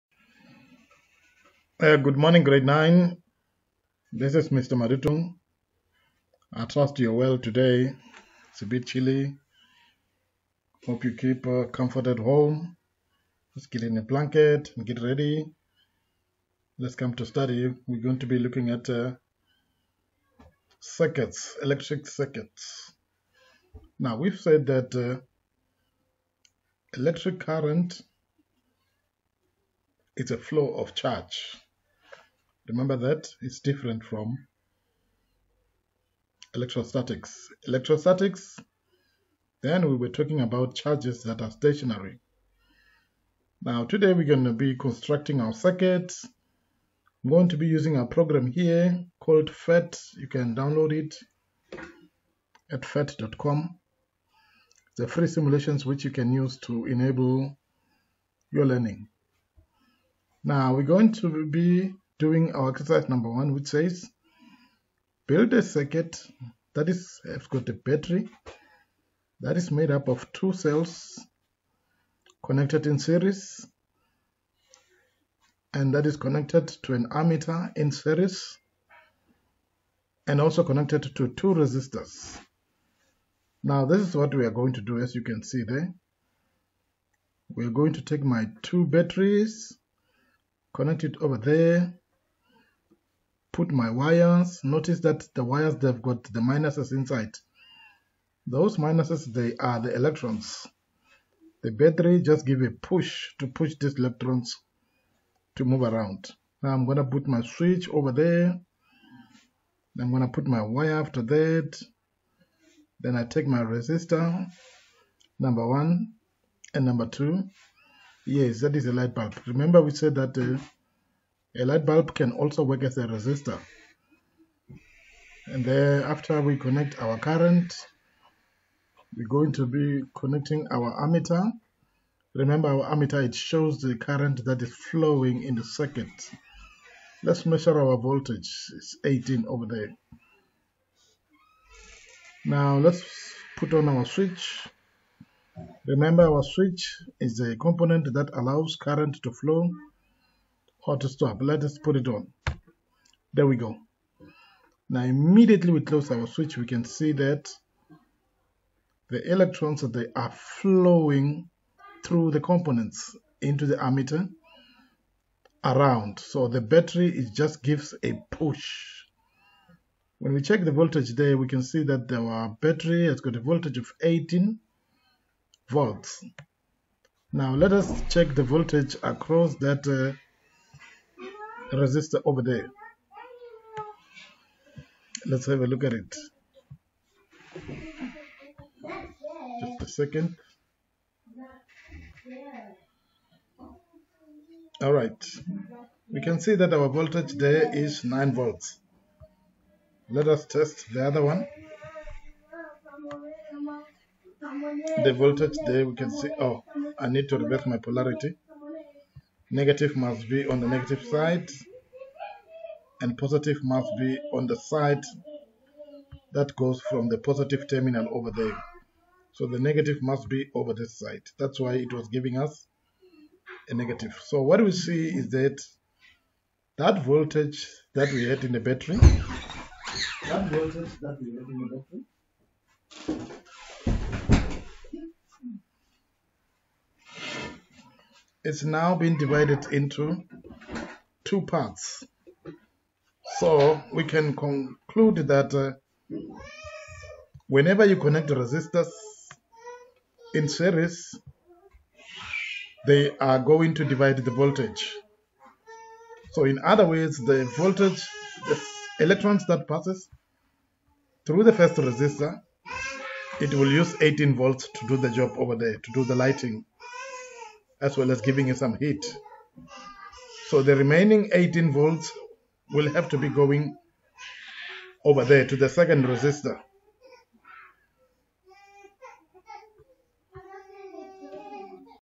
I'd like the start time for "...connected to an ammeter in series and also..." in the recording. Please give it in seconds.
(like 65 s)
76 s.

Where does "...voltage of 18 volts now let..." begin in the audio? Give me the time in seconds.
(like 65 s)
173 s.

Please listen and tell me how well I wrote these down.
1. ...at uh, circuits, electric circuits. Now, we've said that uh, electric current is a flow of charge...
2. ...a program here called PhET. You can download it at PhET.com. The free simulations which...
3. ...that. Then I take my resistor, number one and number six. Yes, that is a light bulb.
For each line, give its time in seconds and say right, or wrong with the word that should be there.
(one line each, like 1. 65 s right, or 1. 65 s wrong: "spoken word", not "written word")
1. 18 s right
2. 47 s right
3. 111 s wrong: "two", not "six".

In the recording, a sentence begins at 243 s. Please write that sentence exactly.
So we can conclude that uh, whenever you connect resistors in series, they are going to divide the voltage.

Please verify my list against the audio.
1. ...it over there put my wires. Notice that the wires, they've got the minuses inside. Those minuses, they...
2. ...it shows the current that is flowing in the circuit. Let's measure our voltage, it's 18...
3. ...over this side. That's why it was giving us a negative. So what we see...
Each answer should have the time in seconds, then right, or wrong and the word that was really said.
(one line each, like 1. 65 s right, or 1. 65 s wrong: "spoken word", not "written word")
1. 91 s right
2. 133 s right
3. 220 s right.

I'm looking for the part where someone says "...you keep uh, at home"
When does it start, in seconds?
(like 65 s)
11 s.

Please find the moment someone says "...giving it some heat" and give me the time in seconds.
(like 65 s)
268 s.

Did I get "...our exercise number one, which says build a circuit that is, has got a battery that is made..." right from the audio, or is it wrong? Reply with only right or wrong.
right.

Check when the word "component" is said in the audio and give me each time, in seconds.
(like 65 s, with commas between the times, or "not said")
147 s, 162 s.